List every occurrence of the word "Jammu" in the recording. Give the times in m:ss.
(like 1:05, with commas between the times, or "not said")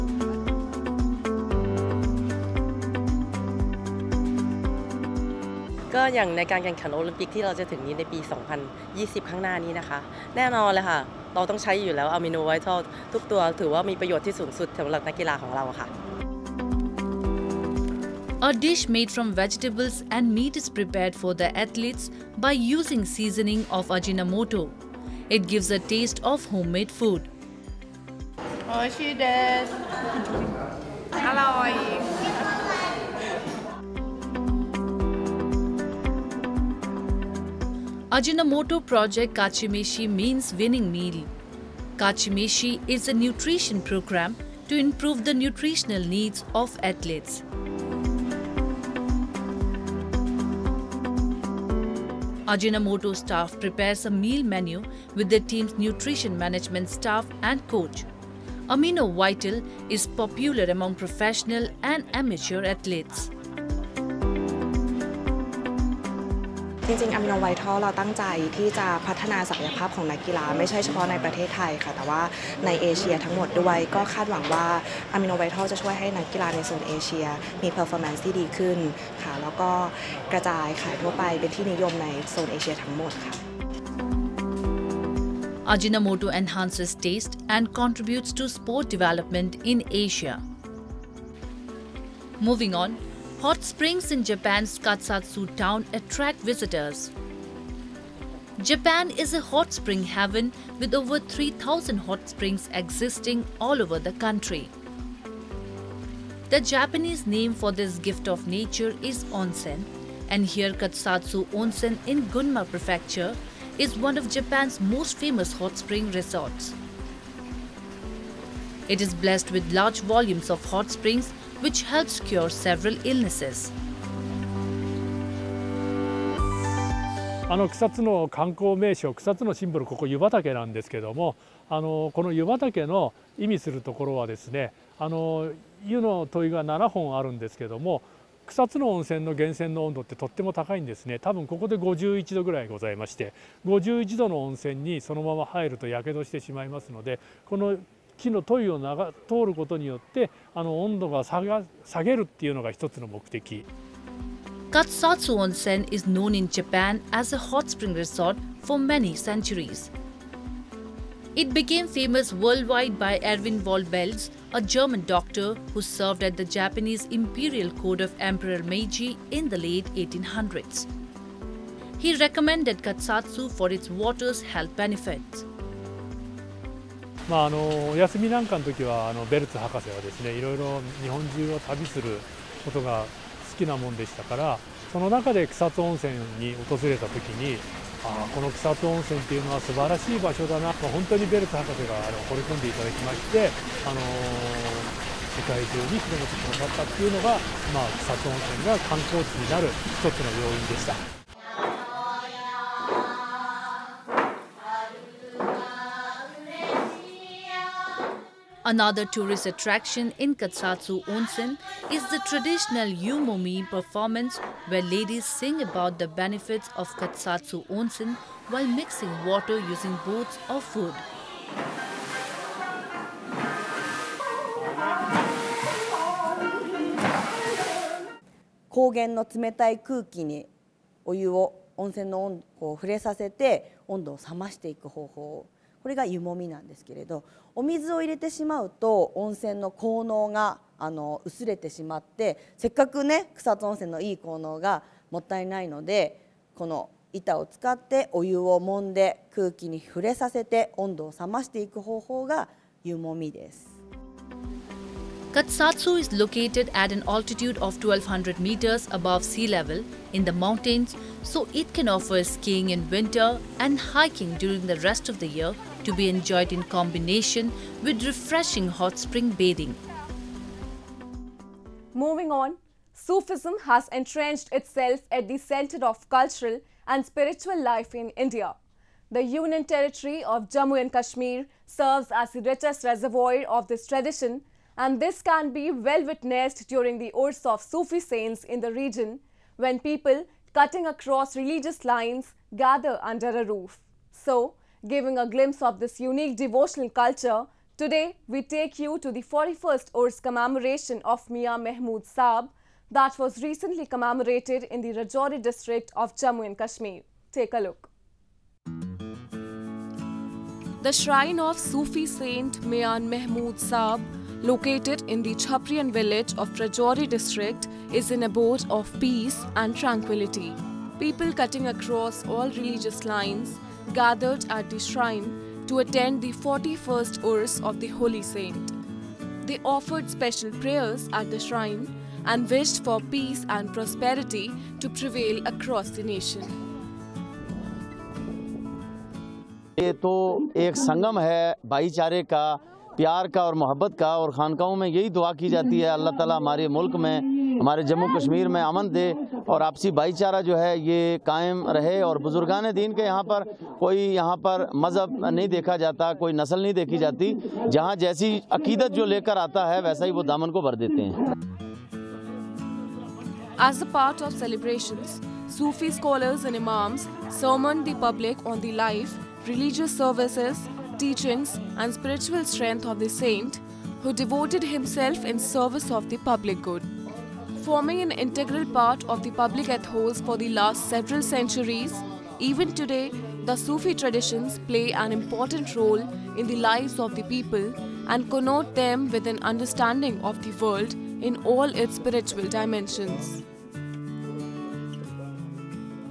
4:40, 5:06.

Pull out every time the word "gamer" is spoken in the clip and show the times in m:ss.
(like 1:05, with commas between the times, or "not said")
not said.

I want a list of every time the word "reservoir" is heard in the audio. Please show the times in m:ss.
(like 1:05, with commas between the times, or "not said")
4:42.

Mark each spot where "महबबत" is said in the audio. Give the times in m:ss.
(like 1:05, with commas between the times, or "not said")
5:43.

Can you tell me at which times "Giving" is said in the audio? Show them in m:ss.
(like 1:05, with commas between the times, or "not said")
4:54.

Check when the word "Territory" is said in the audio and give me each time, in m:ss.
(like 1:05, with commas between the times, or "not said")
4:39.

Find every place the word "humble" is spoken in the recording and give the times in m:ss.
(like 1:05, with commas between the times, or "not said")
not said.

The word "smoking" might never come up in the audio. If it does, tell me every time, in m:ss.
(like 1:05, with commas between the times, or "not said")
not said.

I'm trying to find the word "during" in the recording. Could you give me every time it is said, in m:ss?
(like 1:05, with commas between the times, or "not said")
4:24, 4:46.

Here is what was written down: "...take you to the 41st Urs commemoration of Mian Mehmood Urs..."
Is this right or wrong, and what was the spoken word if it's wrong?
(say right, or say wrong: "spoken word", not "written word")
wrong: "Saab", not "Urs".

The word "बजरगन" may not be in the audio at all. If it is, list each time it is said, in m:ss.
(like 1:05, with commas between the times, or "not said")
5:52.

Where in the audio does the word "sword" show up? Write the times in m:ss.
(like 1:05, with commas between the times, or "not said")
not said.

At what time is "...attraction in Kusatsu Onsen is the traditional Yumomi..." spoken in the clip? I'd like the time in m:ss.
3:29.